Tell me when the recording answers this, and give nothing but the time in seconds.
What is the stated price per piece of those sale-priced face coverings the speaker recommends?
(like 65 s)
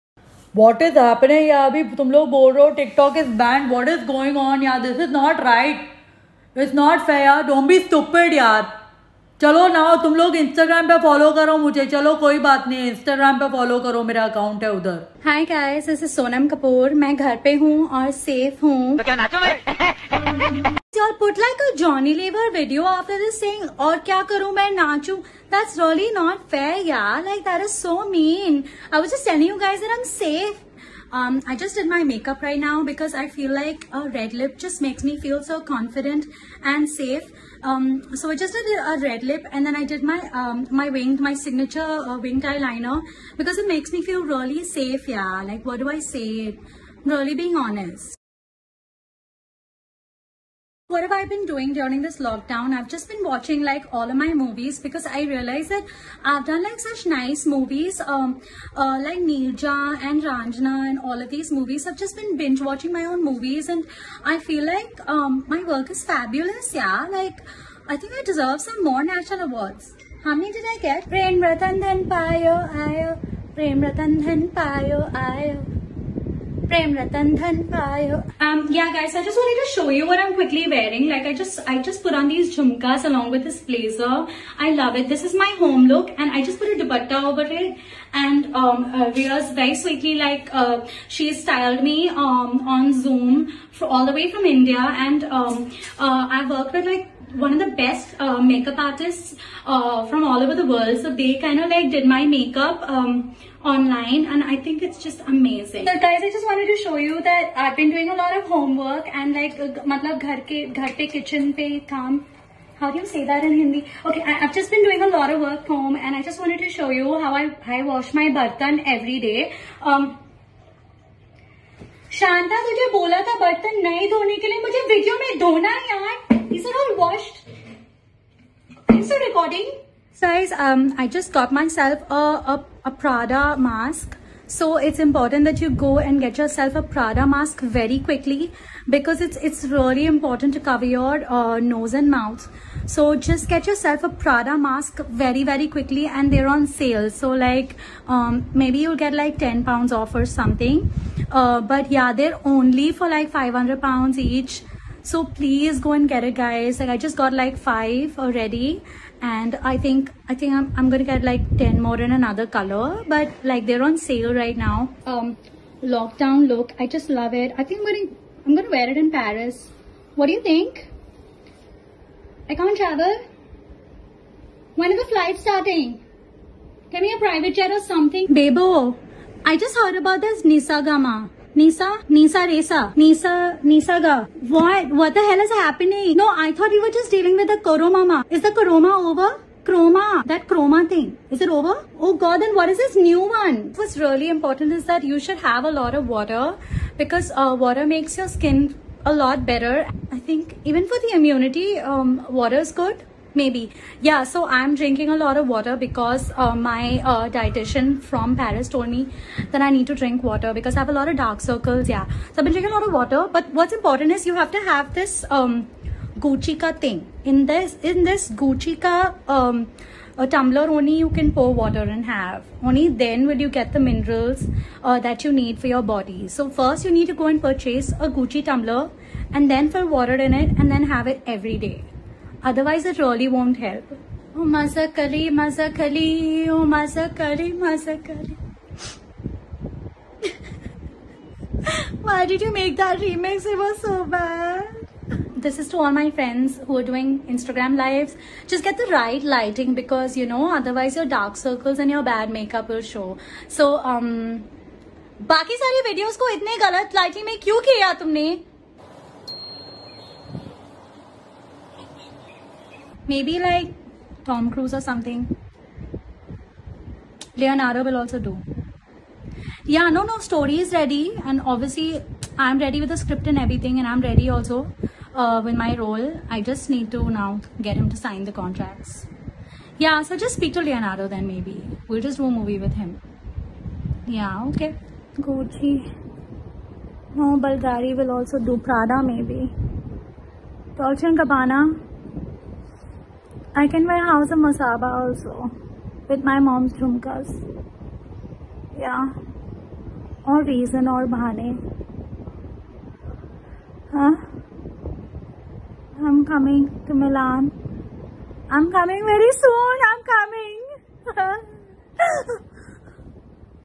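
153 s.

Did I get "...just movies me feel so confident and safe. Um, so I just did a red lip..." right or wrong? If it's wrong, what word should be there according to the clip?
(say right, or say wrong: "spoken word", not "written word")
wrong: "makes", not "movies".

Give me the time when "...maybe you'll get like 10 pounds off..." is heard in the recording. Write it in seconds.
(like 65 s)
148 s.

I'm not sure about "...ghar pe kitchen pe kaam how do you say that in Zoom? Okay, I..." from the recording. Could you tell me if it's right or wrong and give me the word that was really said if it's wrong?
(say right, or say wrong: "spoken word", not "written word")
wrong: "Hindi", not "Zoom".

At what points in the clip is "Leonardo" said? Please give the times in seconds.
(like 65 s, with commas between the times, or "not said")
267 s, 280 s.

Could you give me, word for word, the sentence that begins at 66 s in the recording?
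Yeah, like I think I deserve some more national awards.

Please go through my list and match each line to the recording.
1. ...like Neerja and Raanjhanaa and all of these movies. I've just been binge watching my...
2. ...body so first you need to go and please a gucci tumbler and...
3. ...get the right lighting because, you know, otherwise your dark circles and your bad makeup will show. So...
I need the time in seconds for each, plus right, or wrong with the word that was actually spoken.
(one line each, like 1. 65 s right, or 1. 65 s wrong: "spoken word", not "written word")
1. 59 s right
2. 225 s wrong: "purchase", not "please"
3. 248 s right.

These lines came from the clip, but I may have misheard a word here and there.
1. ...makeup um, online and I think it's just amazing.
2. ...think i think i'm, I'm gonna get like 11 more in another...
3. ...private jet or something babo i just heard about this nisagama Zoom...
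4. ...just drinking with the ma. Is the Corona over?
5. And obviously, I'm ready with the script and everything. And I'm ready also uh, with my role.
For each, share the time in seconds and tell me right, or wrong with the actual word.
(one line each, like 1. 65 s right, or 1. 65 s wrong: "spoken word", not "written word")
1. 102 s right
2. 159 s wrong: "10", not "11"
3. 177 s wrong: "Nisa", not "Zoom"
4. 186 s wrong: "dealing", not "drinking"
5. 271 s right.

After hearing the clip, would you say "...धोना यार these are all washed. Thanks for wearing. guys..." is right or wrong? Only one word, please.
wrong.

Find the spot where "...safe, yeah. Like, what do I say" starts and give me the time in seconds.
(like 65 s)
44 s.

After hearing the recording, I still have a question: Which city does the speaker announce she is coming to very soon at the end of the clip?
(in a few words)
Milan.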